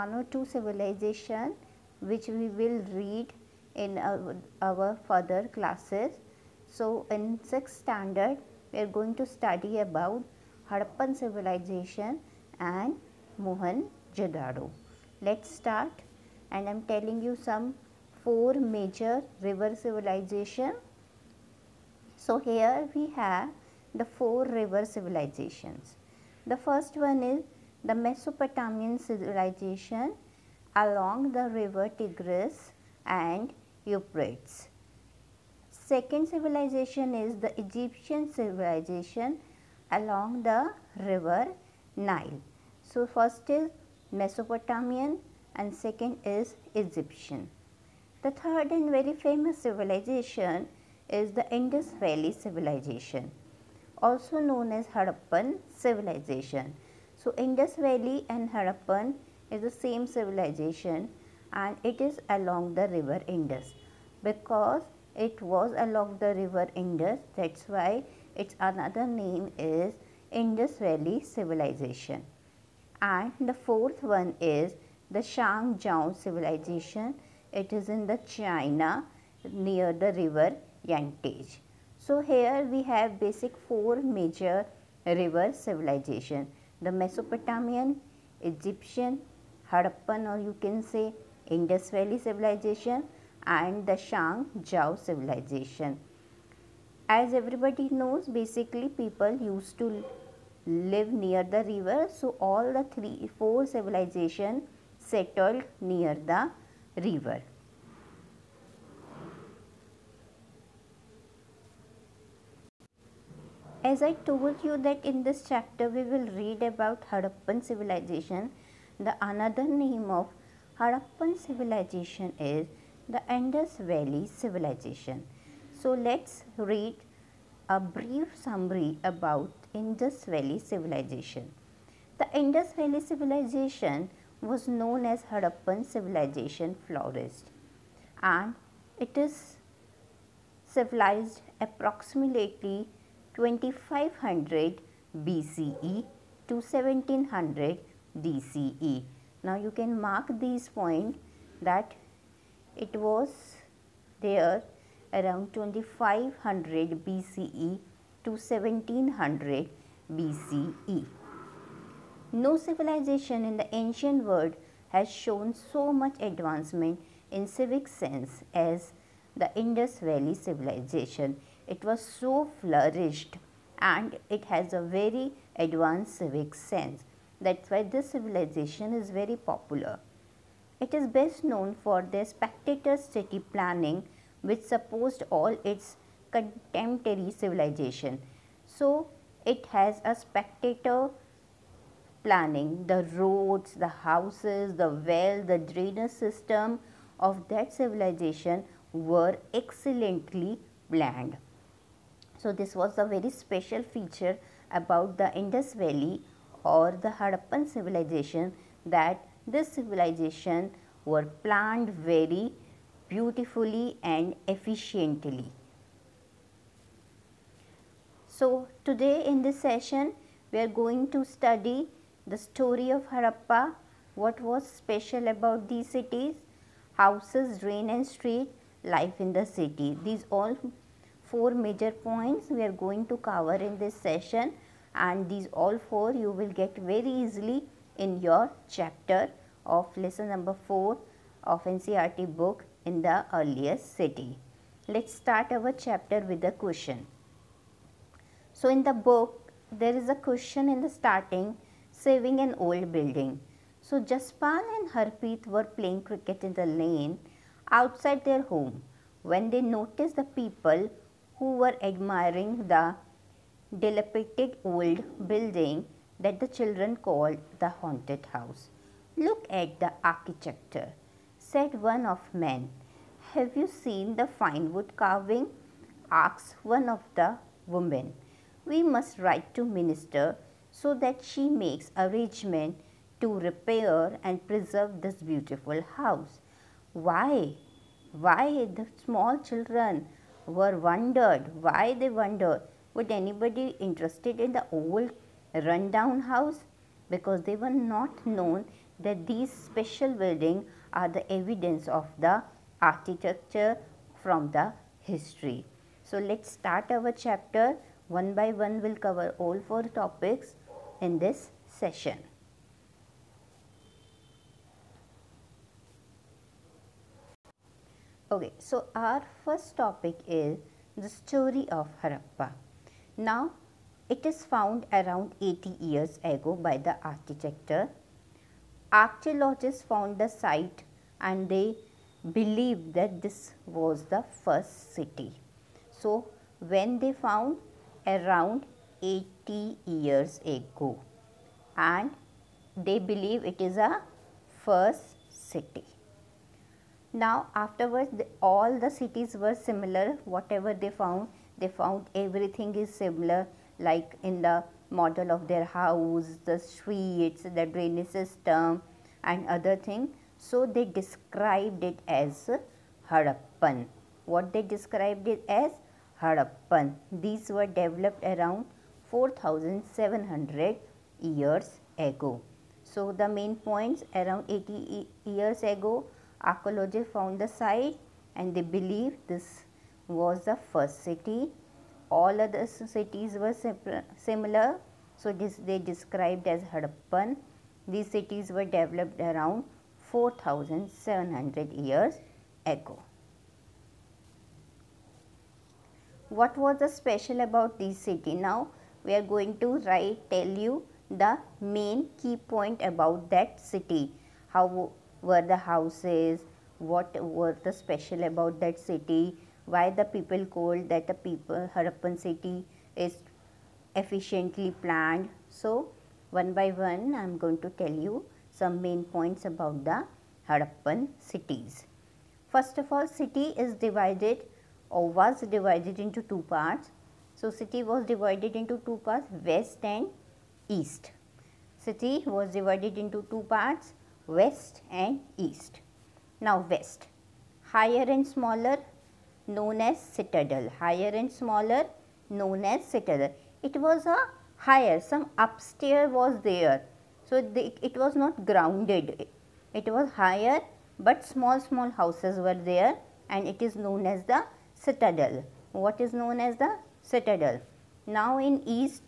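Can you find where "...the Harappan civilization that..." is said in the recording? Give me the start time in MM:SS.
03:26.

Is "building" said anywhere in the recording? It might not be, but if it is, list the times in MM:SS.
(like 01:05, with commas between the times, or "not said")
04:12, 04:25, 05:00.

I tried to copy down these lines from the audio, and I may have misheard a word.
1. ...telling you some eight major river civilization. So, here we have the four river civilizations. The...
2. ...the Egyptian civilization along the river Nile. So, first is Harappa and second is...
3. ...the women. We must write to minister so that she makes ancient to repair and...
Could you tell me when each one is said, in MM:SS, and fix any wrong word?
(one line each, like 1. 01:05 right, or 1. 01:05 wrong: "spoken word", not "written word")
1. 00:16 wrong: "four", not "eight"
2. 00:37 wrong: "Mesopotamian", not "Harappa"
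3. 04:37 wrong: "arrangement", not "ancient".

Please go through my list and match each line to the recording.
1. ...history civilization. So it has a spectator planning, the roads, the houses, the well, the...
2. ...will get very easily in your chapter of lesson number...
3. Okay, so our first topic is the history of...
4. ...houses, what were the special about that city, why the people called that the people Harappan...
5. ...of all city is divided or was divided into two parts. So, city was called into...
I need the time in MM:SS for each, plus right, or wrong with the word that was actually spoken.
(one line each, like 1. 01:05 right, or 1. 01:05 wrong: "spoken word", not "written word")
1. 03:06 wrong: "contemporary", not "history"
2. 03:56 right
3. 05:18 wrong: "story", not "history"
4. 06:45 right
5. 07:02 wrong: "divided", not "called".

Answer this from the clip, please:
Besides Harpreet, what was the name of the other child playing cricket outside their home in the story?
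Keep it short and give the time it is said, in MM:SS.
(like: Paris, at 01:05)
Jaspal, at 04:14.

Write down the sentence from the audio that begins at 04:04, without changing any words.
Let's start our chapter with a question.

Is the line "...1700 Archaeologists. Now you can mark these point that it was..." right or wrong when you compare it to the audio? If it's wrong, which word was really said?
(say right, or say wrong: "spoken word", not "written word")
wrong: "BCE", not "Archaeologists".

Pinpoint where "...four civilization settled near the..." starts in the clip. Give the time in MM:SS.
01:43.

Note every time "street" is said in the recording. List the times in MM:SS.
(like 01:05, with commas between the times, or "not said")
03:48, 05:56.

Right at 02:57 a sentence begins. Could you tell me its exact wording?
That's why this civilization is very popular.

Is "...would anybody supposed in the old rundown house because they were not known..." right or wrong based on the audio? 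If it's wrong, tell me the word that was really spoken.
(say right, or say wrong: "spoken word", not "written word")
wrong: "interested", not "supposed".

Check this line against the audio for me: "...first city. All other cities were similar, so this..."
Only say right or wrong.
right.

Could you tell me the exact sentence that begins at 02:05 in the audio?
So let's read a brief summary about Indus Valley civilization.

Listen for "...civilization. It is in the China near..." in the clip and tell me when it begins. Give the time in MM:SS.
01:16.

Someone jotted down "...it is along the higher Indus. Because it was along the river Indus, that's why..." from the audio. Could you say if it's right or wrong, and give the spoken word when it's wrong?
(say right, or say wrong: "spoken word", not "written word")
wrong: "river", not "higher".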